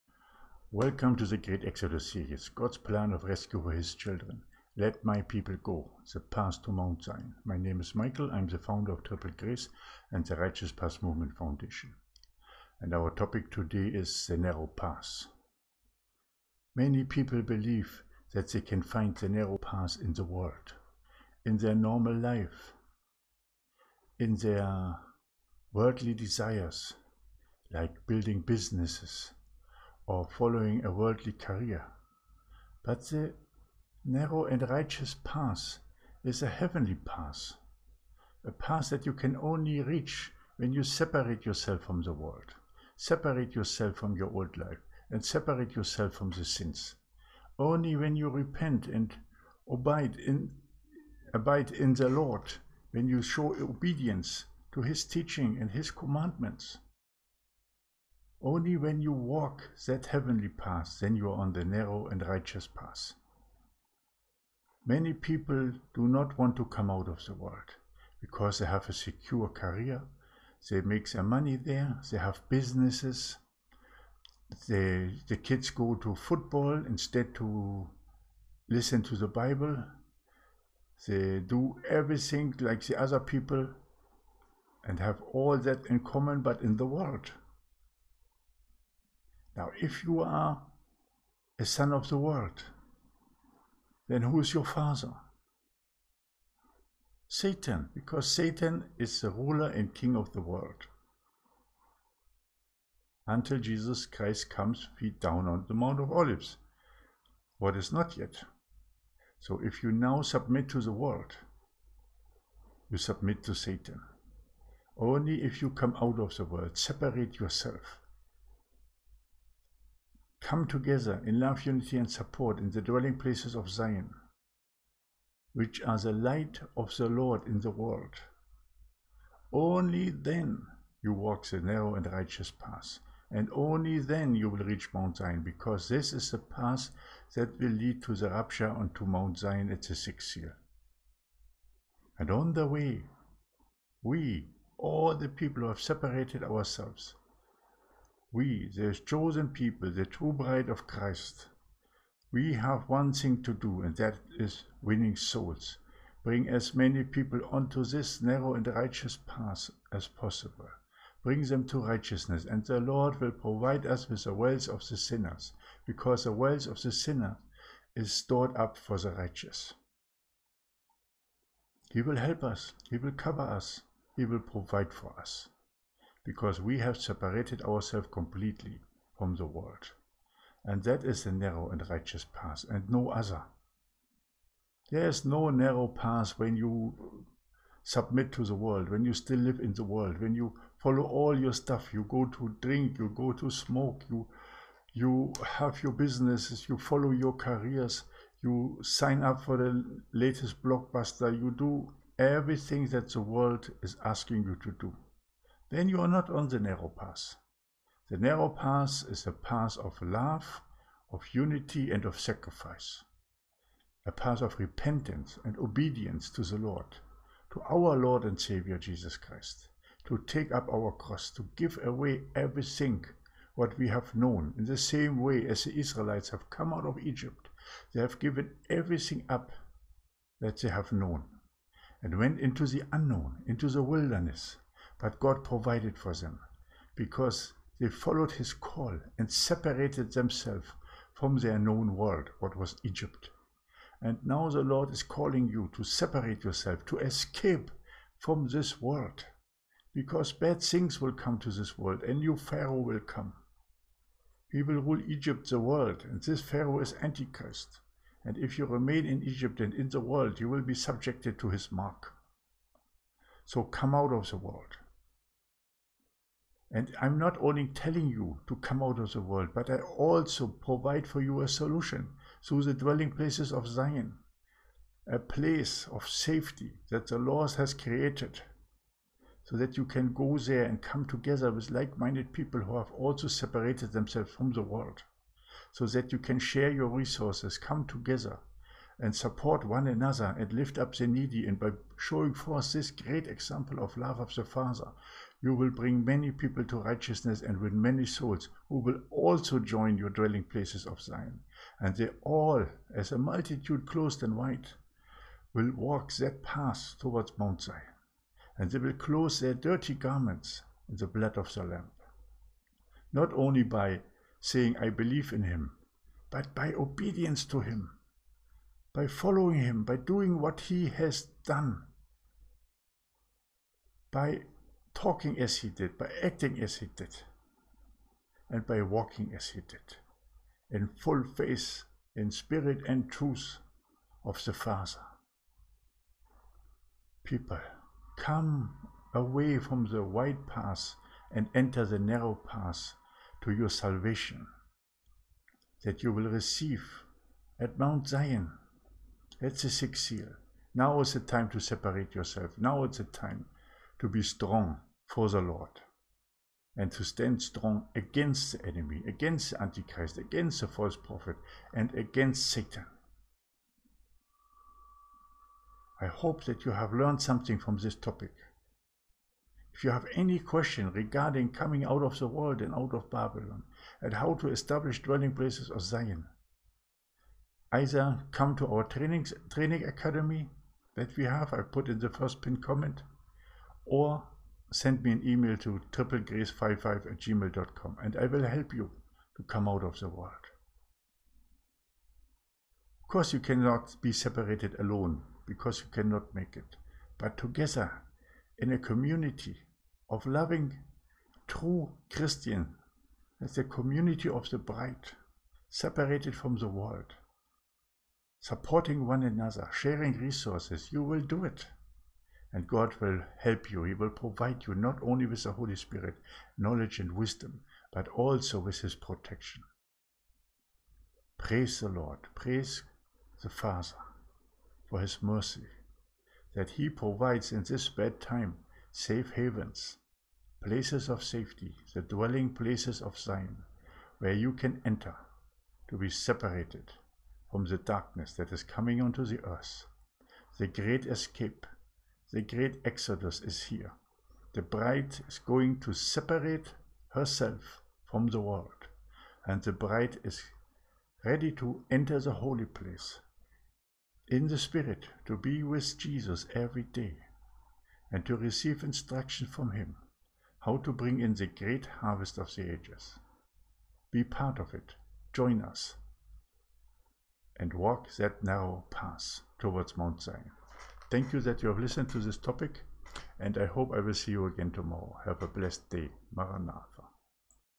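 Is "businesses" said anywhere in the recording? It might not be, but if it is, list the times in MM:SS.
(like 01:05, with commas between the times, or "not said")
00:28, 01:12, 03:15.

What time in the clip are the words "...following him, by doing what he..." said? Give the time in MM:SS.
05:19.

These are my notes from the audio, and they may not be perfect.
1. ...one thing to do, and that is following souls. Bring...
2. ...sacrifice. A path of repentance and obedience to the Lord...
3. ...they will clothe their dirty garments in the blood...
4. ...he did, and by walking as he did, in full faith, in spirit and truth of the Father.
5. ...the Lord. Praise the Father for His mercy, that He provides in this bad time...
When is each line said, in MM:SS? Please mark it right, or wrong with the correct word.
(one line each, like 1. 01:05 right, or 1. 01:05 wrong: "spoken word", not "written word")
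1. 02:32 wrong: "winning", not "following"
2. 03:32 right
3. 05:08 right
4. 05:26 right
5. 07:01 right.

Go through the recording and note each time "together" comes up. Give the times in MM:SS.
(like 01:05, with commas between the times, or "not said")
02:00, 04:41, 04:47, 06:37.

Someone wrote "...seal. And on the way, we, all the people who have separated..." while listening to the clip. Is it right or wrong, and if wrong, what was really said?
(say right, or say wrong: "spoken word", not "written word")
right.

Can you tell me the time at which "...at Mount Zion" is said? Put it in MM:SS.
05:47.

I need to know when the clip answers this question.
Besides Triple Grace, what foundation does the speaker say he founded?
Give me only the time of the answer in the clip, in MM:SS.
00:10.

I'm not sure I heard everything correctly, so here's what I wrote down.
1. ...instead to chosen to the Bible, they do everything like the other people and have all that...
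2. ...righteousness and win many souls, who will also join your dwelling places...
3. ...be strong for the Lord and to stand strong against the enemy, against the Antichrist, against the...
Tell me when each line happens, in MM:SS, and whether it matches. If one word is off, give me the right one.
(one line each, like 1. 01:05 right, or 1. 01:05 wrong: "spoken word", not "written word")
1. 01:16 wrong: "listen", not "chosen"
2. 04:56 right
3. 05:54 right.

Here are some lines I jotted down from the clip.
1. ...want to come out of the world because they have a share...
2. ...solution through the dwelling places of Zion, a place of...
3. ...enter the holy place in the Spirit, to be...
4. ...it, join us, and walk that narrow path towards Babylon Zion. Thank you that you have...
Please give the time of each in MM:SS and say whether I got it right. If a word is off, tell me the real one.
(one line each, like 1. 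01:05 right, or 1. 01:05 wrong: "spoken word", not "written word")
1. 01:06 wrong: "secure", not "share"
2. 04:31 right
3. 07:31 right
4. 07:44 wrong: "Mount", not "Babylon".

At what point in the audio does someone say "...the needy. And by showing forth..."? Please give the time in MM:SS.
04:50.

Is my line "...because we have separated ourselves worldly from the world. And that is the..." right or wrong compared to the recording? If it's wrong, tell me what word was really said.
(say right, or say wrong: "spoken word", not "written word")
wrong: "completely", not "worldly".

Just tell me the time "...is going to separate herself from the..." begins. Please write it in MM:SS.
07:25.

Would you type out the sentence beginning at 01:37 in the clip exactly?
Satan, because Satan is the ruler and king of the world.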